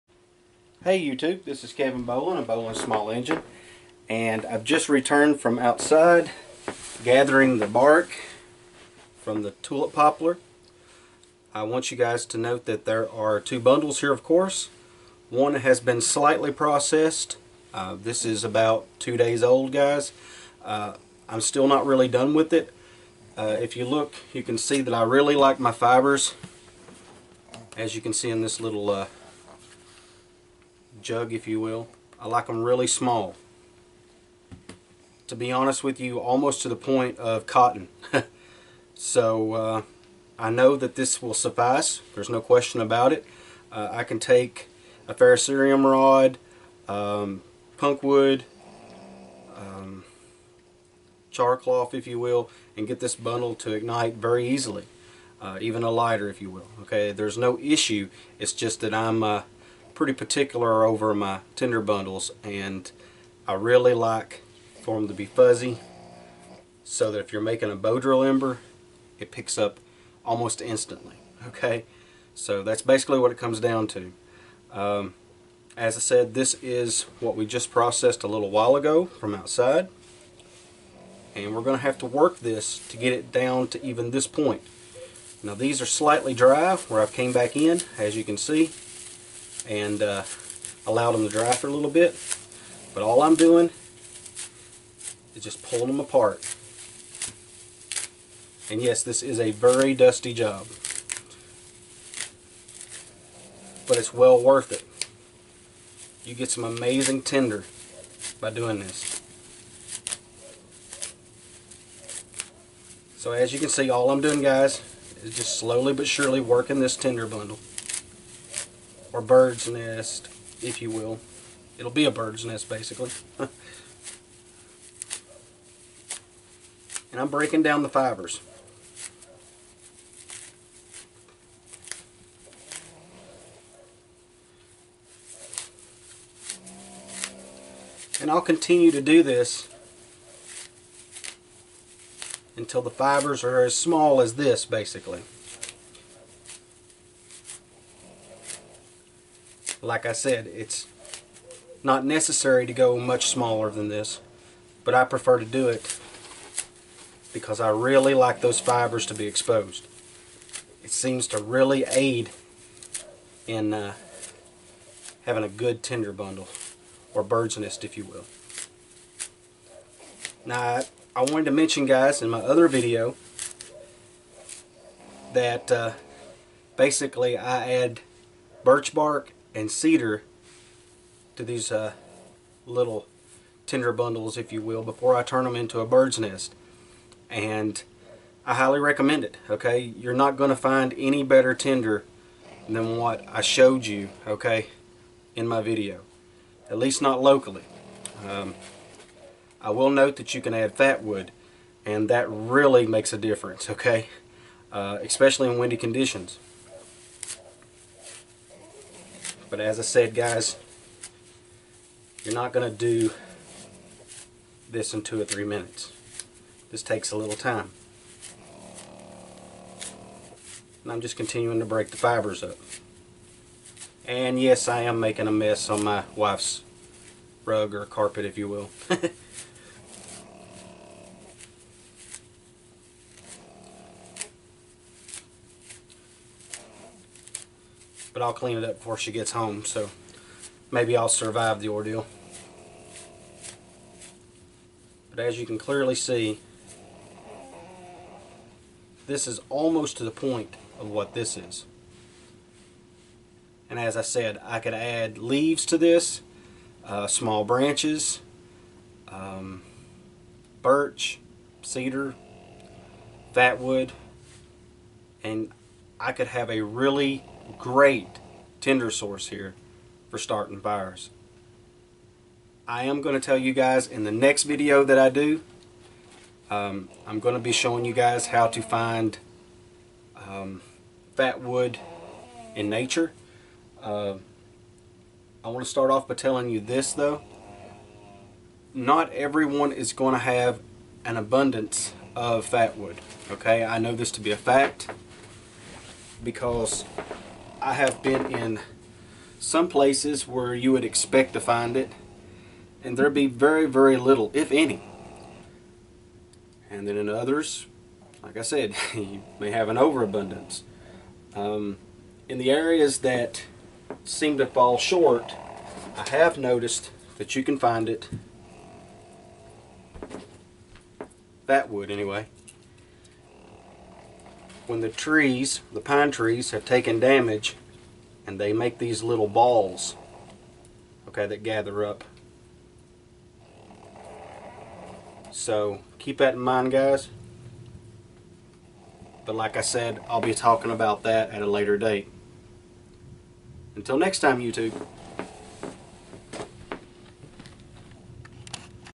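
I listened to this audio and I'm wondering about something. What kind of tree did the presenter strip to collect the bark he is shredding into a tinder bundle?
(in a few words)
tulip poplar.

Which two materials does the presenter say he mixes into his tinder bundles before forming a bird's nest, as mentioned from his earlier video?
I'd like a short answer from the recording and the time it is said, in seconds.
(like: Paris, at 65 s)
birch bark and cedar, at 178 s.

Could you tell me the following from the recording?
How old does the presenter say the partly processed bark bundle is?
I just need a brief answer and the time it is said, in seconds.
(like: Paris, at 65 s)
2 days, at 18 s.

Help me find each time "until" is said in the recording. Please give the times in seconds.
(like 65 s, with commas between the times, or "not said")
142 s, 343 s.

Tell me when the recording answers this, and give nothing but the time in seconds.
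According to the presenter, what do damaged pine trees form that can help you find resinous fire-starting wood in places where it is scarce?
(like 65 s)
329 s.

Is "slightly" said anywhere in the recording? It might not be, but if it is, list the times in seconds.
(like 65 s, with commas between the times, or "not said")
16 s, 85 s.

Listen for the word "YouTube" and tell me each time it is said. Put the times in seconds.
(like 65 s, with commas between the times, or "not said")
1 s, 344 s.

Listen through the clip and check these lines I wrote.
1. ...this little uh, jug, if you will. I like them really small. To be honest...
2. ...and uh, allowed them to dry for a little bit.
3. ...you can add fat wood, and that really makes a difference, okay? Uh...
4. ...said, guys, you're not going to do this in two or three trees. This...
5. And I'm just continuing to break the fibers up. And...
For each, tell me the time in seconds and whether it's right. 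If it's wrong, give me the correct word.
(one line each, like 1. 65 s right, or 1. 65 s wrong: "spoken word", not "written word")
1. 28 s right
2. 89 s right
3. 200 s right
4. 209 s wrong: "minutes", not "trees"
5. 220 s right.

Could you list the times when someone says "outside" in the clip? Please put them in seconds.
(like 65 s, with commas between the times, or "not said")
5 s, 79 s.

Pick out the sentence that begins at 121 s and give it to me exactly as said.
It'll be a bird's nest, basically.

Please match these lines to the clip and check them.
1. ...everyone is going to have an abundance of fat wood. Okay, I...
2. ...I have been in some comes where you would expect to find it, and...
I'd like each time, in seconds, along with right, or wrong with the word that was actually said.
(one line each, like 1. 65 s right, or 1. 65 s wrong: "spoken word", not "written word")
1. 289 s right
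2. 297 s wrong: "places", not "comes".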